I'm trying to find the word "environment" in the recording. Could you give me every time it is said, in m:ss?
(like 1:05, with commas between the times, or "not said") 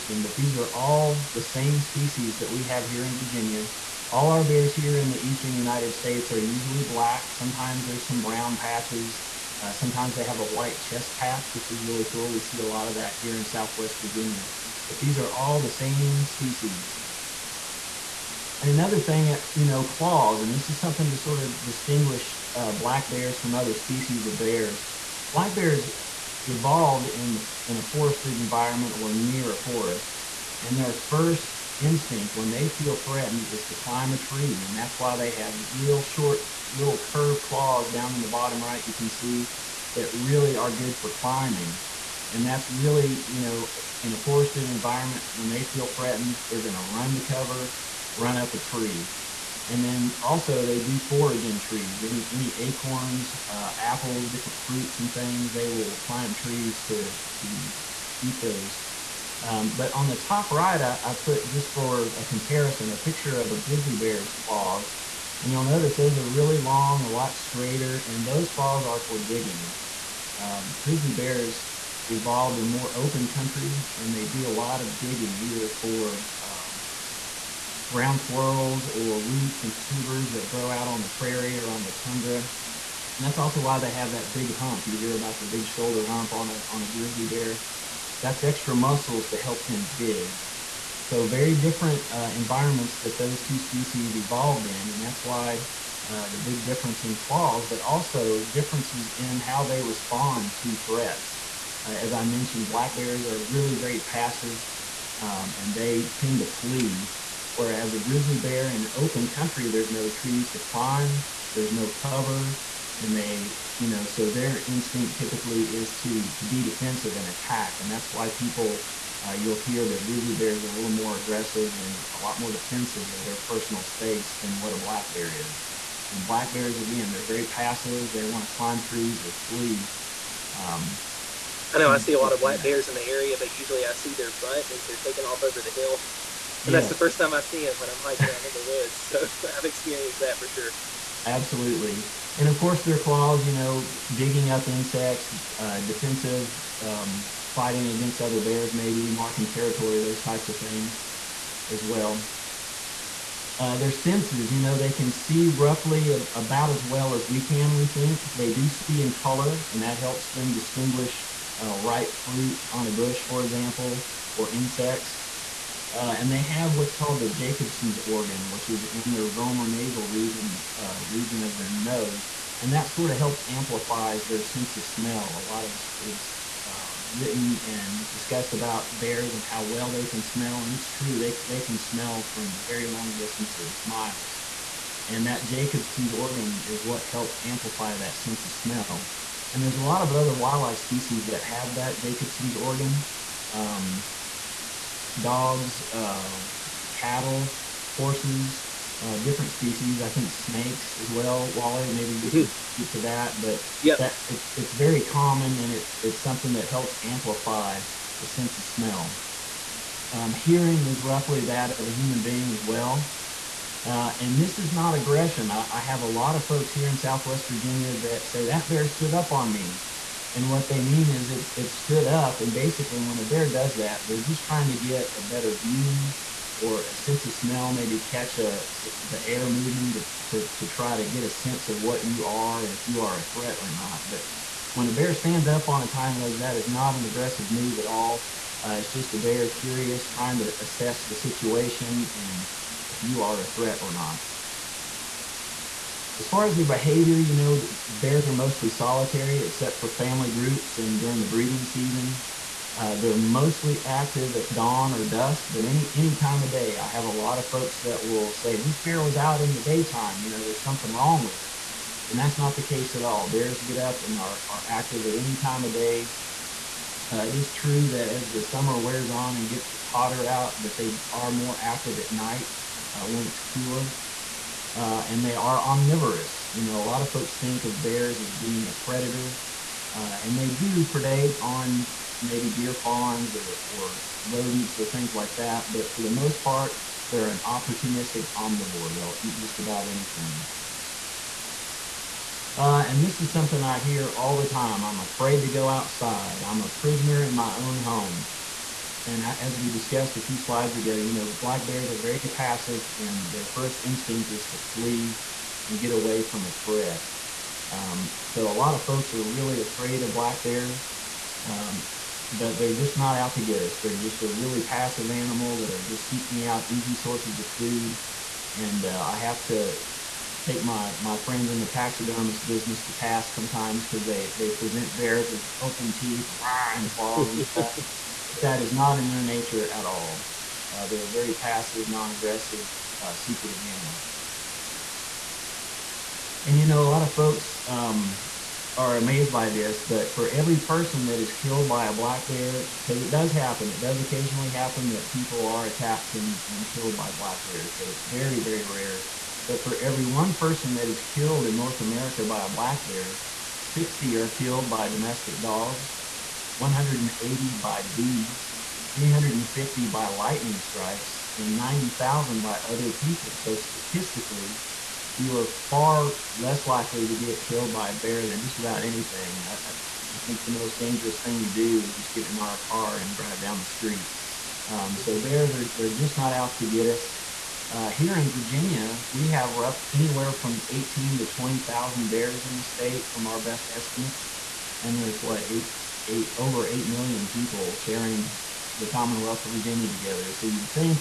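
0:28, 0:44, 1:32.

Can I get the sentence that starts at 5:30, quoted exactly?
Uh, they're a very passive, non-aggressive, uh, secretive animal.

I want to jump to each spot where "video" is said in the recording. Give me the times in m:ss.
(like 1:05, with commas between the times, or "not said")
not said.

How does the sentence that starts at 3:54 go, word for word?
But when a bear stands up on its hind legs, that is not an aggressive move at all.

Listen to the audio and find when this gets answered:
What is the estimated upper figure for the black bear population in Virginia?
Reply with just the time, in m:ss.
6:21.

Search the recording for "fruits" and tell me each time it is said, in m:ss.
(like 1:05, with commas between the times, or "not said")
0:54, 2:42.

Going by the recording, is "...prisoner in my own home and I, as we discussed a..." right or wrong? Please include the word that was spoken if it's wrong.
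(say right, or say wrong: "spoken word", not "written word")
right.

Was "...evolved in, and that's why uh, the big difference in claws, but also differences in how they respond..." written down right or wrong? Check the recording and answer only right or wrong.
right.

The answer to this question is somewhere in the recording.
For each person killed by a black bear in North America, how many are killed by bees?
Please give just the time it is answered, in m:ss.
5:56.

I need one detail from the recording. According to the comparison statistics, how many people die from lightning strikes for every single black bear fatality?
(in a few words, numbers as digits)
350.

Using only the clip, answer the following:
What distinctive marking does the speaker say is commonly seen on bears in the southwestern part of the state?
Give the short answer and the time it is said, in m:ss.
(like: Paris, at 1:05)
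White chest patch, at 0:10.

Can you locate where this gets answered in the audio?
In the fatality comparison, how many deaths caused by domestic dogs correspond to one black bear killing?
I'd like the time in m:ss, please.
5:53.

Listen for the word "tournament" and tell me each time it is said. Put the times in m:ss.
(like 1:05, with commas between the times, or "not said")
not said.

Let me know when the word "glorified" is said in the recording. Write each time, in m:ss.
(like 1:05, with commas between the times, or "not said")
not said.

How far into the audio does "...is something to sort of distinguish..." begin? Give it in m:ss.
0:20.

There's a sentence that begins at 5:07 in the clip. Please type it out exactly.
Um, so a lot of folks are really afraid of black bears, um, but they're just not out to get us.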